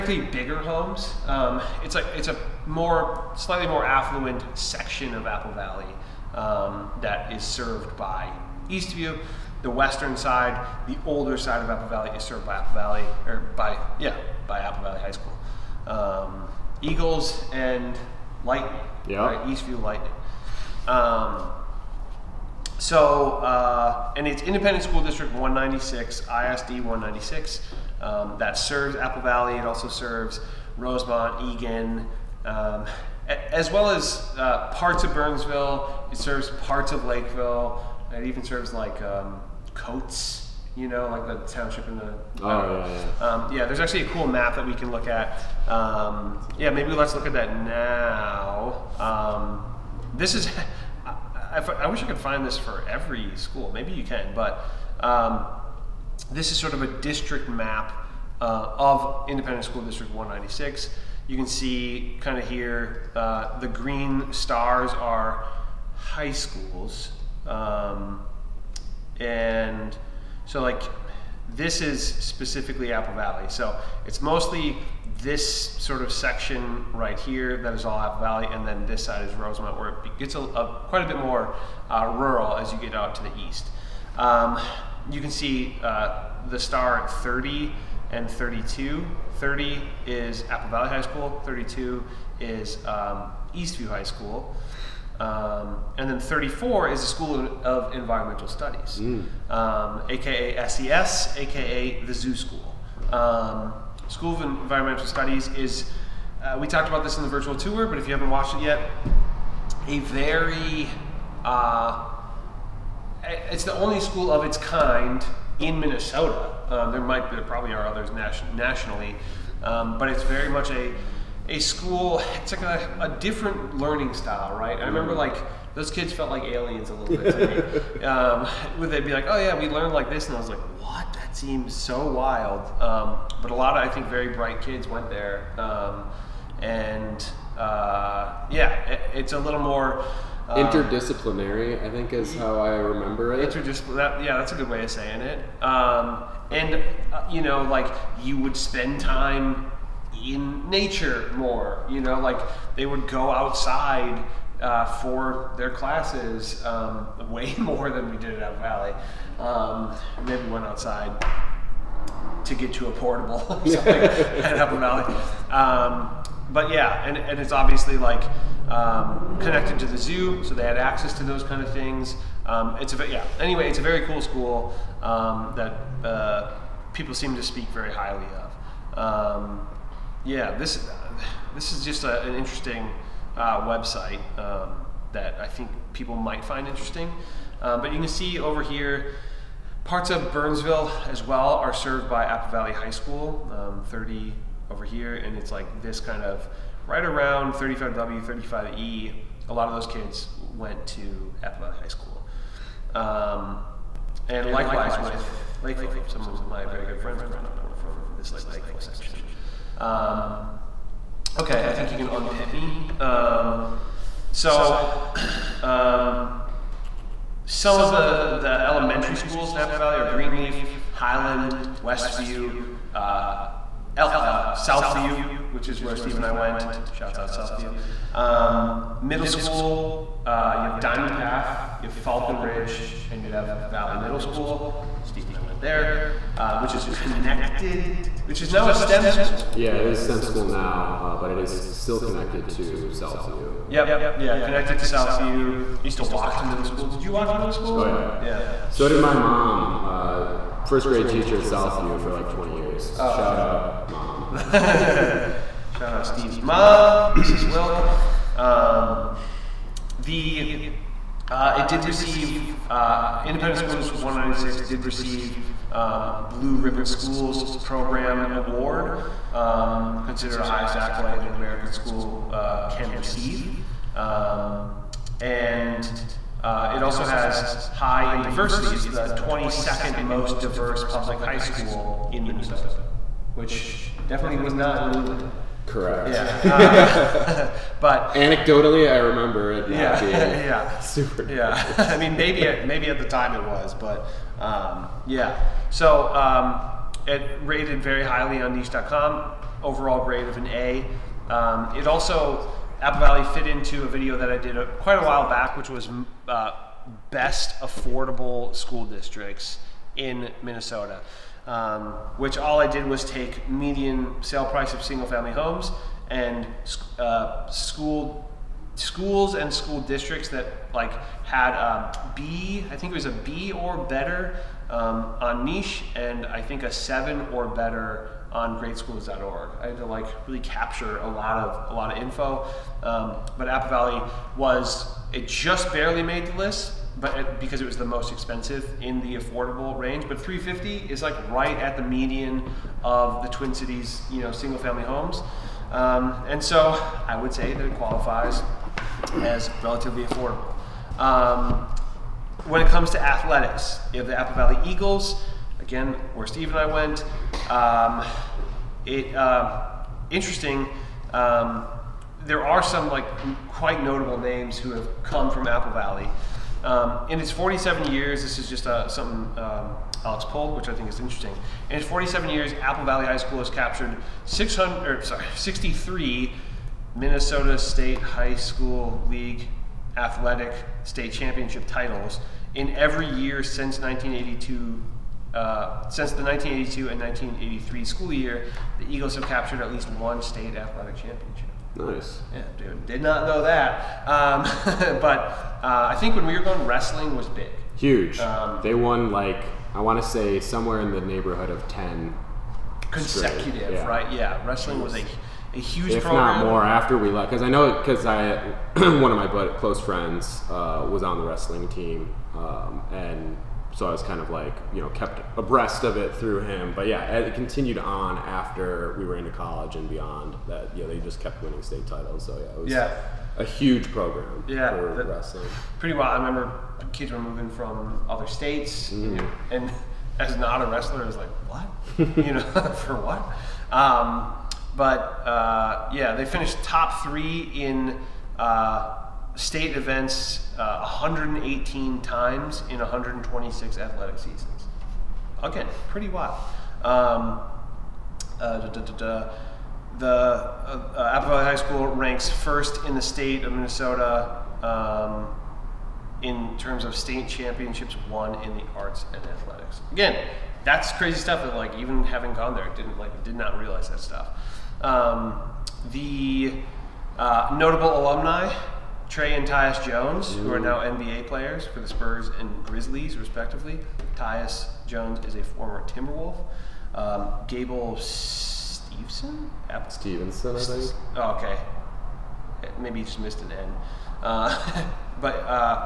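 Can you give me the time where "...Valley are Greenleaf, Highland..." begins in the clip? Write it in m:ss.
3:39.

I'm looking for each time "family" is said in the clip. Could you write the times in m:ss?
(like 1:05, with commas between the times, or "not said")
5:15, 5:44.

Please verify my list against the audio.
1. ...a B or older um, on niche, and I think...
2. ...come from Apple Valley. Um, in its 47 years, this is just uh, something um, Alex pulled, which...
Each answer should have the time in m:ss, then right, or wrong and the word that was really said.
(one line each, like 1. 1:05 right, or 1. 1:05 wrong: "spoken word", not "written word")
1. 5:23 wrong: "better", not "older"
2. 6:05 right.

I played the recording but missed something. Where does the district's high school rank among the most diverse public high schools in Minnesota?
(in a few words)
22nd.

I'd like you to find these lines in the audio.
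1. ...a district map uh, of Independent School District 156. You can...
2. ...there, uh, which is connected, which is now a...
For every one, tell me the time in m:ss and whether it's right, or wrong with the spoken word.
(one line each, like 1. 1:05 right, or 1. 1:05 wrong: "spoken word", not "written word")
1. 0:56 wrong: "196", not "156"
2. 3:55 right.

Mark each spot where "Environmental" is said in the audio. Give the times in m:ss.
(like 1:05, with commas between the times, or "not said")
1:37, 1:44.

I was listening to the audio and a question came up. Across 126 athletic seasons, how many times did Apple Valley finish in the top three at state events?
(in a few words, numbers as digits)
118.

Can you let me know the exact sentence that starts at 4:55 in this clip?
So um, it rated very highly on niche.com.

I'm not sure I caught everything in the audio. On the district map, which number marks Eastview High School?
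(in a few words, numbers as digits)
32.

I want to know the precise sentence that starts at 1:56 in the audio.
Um, there might there probably are others nation, nationally, um, but it's very much a a school.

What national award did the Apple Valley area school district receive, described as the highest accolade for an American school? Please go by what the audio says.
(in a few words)
Blue Ribbon Schools Program Award.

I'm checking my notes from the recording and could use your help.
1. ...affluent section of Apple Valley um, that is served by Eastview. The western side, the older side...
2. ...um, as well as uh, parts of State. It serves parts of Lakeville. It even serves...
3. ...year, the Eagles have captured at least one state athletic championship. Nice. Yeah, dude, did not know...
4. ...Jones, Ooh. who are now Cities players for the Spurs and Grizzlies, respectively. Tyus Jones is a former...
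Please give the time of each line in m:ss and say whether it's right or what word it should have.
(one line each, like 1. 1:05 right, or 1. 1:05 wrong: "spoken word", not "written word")
1. 0:03 right
2. 0:32 wrong: "Burnsville", not "State"
3. 6:28 right
4. 7:49 wrong: "NBA", not "Cities".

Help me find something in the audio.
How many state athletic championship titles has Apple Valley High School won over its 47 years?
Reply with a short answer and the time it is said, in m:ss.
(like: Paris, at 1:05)
63, at 6:15.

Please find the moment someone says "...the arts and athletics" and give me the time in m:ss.
7:38.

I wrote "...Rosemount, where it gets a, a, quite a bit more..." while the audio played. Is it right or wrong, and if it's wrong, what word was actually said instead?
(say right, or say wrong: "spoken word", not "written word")
right.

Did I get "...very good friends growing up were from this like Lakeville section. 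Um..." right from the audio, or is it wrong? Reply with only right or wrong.
right.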